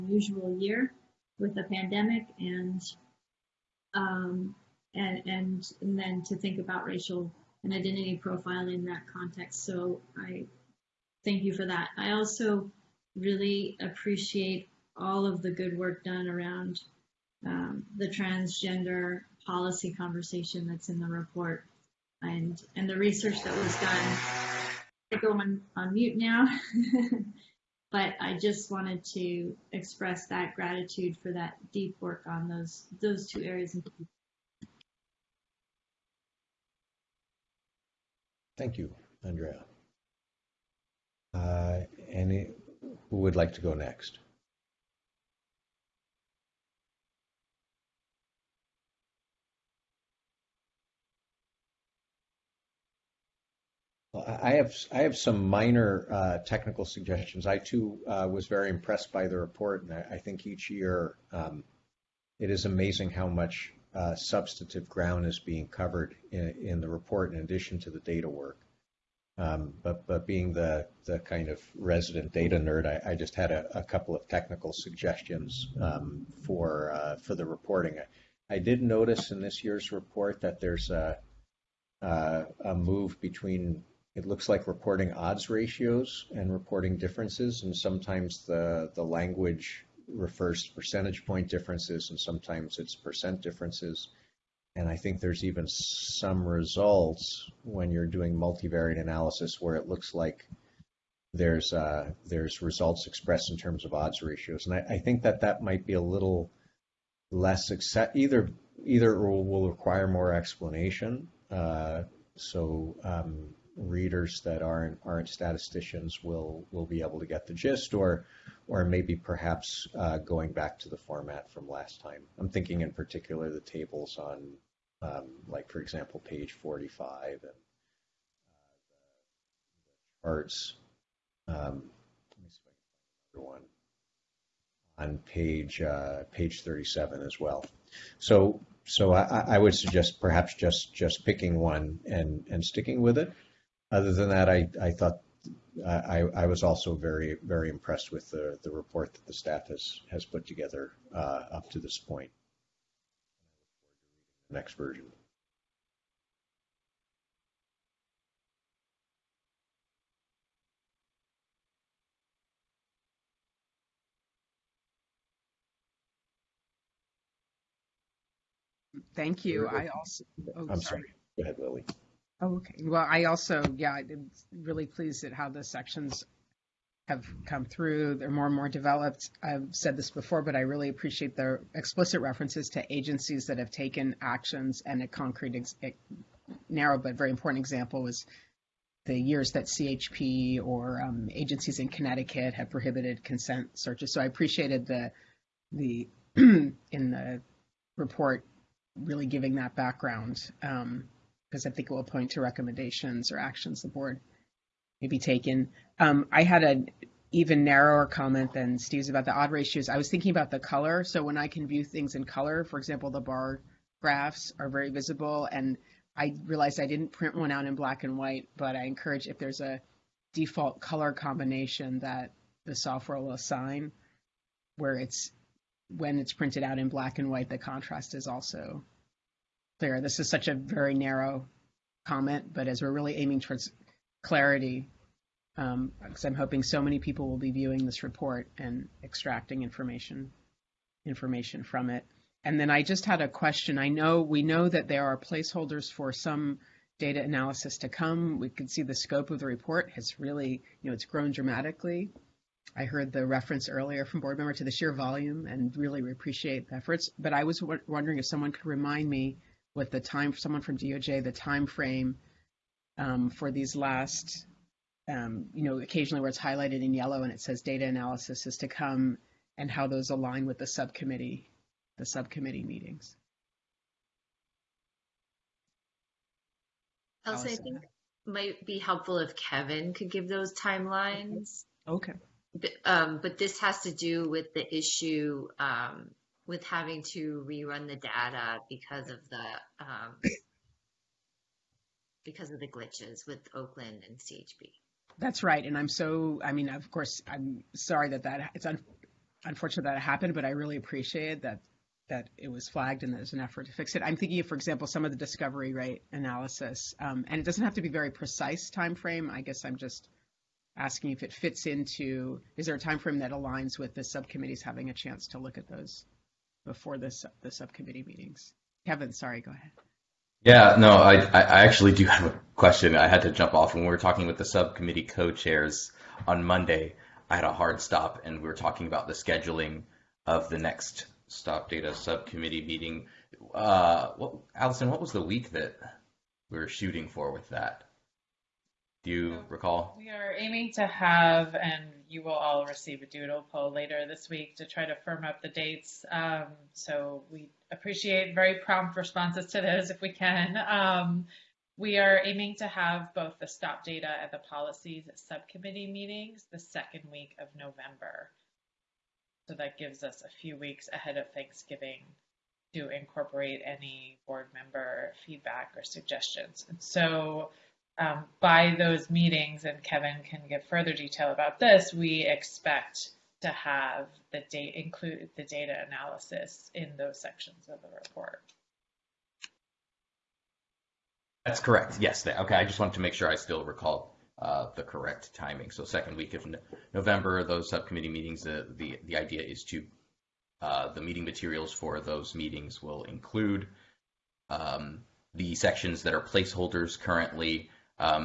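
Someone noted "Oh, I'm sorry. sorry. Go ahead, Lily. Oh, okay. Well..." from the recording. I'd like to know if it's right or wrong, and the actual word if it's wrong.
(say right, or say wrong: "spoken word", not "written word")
right.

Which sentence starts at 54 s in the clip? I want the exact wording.
Well, I have I have some minor uh, technical suggestions.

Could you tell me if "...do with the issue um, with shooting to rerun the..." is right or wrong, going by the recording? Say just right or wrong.
wrong.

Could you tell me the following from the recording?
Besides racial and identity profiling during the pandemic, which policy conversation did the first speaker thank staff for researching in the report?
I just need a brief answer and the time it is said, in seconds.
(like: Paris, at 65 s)
transgender policy, at 18 s.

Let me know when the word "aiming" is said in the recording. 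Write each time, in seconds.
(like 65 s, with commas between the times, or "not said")
233 s, 340 s, 352 s.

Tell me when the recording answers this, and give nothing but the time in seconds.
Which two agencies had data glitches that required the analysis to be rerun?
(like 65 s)
293 s.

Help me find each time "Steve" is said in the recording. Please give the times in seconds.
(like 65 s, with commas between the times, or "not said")
208 s.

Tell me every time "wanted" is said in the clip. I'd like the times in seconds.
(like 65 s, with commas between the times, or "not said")
28 s, 382 s.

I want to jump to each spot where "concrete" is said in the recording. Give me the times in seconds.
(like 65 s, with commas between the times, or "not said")
185 s.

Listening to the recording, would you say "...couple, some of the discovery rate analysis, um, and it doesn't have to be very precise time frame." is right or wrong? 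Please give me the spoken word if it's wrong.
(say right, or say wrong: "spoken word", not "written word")
wrong: "example", not "couple".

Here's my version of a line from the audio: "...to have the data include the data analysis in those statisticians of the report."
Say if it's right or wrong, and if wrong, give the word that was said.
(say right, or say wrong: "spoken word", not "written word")
wrong: "sections", not "statisticians".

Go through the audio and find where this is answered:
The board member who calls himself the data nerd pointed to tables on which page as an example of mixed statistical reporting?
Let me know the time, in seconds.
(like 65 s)
126 s.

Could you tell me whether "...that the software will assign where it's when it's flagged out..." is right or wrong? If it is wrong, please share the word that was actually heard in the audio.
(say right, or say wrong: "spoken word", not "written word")
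wrong: "printed", not "flagged".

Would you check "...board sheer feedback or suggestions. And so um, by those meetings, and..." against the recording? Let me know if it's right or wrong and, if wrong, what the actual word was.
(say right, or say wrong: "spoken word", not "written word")
wrong: "member", not "sheer".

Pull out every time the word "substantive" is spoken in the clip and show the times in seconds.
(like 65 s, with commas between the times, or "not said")
64 s.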